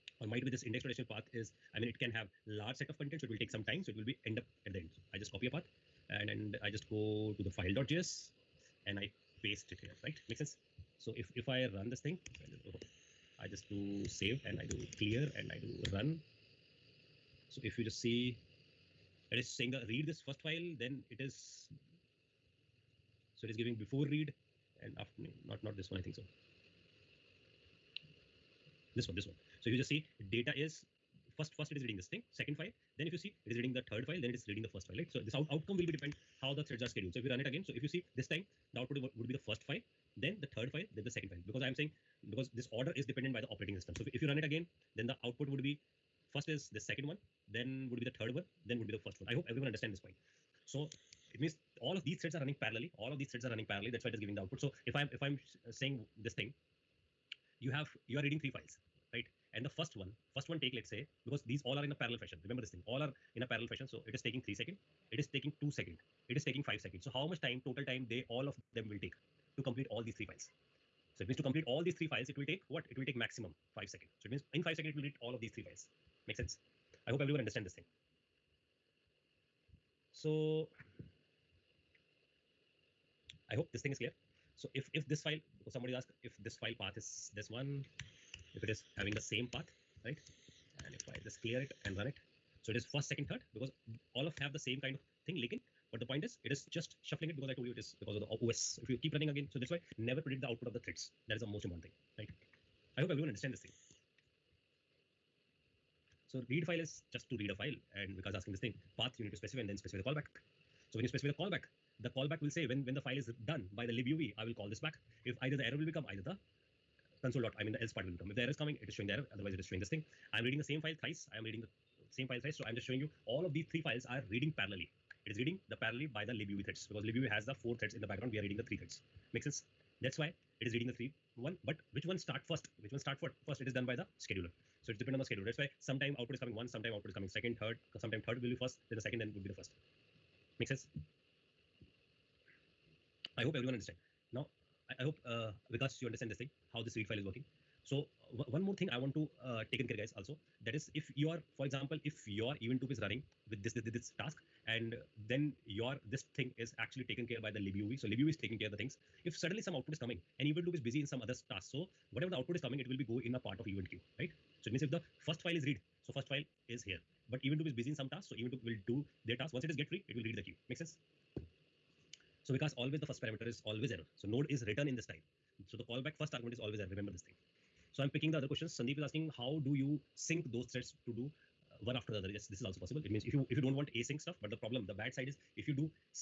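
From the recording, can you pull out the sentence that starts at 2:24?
Now, I, I hope uh, Vikas, you understand this thing, how this read file is working.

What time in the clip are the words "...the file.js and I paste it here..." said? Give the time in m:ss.
0:07.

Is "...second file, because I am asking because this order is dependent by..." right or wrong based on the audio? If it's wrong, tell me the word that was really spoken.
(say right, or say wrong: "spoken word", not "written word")
wrong: "saying", not "asking".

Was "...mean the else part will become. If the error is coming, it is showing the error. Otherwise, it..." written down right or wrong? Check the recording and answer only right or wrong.
right.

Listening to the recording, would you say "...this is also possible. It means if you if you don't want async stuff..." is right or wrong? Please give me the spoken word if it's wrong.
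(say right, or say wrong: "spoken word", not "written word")
right.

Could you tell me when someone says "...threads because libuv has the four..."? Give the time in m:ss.
2:06.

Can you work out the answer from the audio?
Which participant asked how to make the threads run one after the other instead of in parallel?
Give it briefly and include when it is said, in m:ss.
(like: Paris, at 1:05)
Sandeep, at 2:58.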